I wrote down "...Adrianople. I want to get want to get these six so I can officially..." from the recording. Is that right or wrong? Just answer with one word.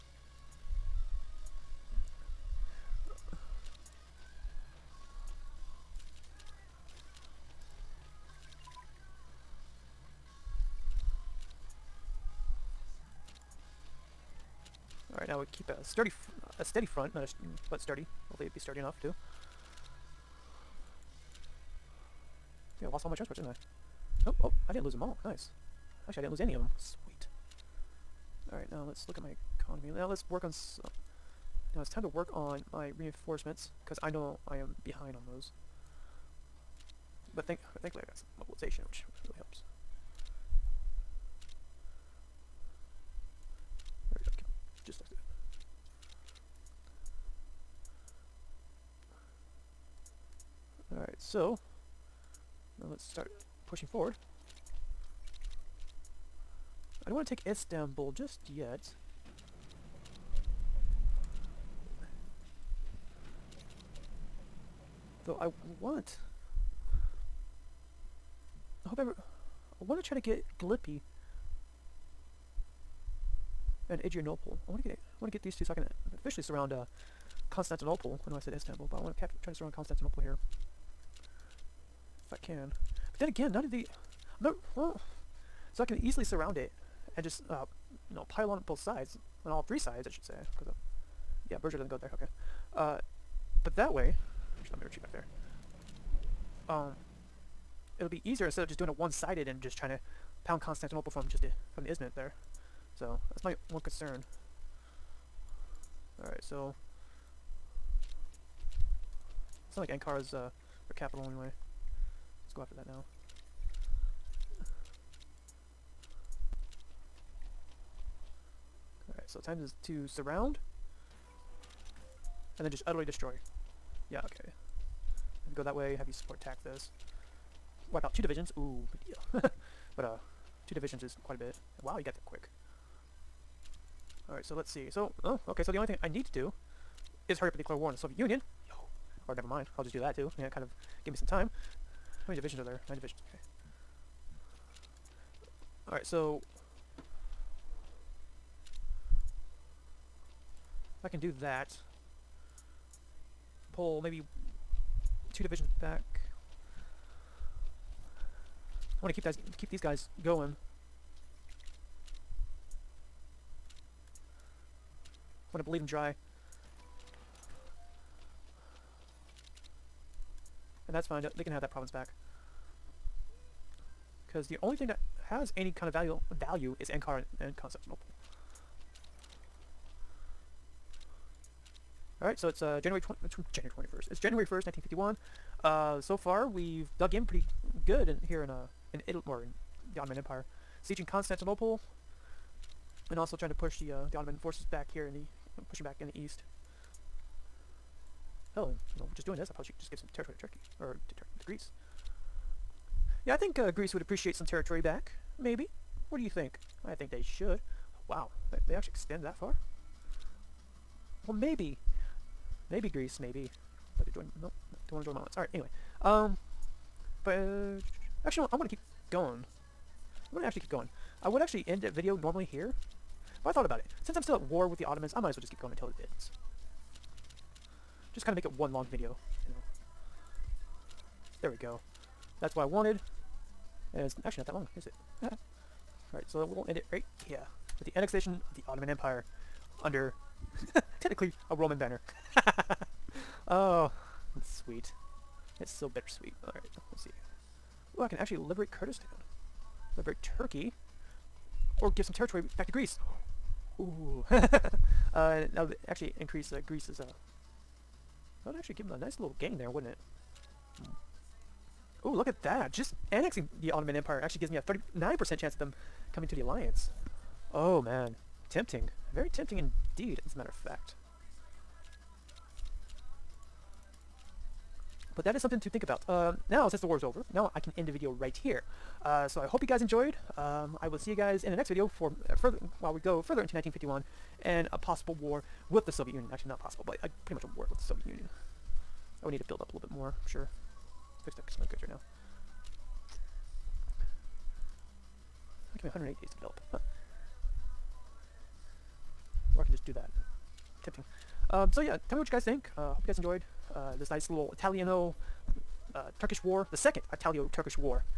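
wrong.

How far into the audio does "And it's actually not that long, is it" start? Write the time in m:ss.
3:53.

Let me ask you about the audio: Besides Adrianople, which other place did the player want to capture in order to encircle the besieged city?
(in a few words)
Glippy.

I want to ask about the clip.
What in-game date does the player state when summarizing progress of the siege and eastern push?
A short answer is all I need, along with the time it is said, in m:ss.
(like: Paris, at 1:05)
January 1st, 1951, at 3:04.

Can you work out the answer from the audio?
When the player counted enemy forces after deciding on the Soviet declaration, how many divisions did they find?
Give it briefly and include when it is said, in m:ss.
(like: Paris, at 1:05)
9, at 2:22.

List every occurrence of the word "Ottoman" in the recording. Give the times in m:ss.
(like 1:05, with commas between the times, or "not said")
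3:09, 3:14, 3:44, 3:58, 4:23.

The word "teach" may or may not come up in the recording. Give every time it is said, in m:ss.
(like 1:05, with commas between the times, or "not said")
not said.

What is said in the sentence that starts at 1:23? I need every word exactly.
But then again, none of the...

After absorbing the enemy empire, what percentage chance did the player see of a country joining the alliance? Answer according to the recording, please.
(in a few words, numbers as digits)
39%.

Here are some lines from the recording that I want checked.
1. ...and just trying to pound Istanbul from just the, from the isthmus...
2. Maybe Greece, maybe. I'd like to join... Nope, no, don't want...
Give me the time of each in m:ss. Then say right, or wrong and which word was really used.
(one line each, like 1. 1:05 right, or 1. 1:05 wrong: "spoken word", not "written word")
1. 1:39 wrong: "Constantinople", not "Istanbul"
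2. 3:32 right.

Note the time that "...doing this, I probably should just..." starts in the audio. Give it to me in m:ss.
3:19.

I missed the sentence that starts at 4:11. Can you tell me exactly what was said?
Or give some territory back to Greece.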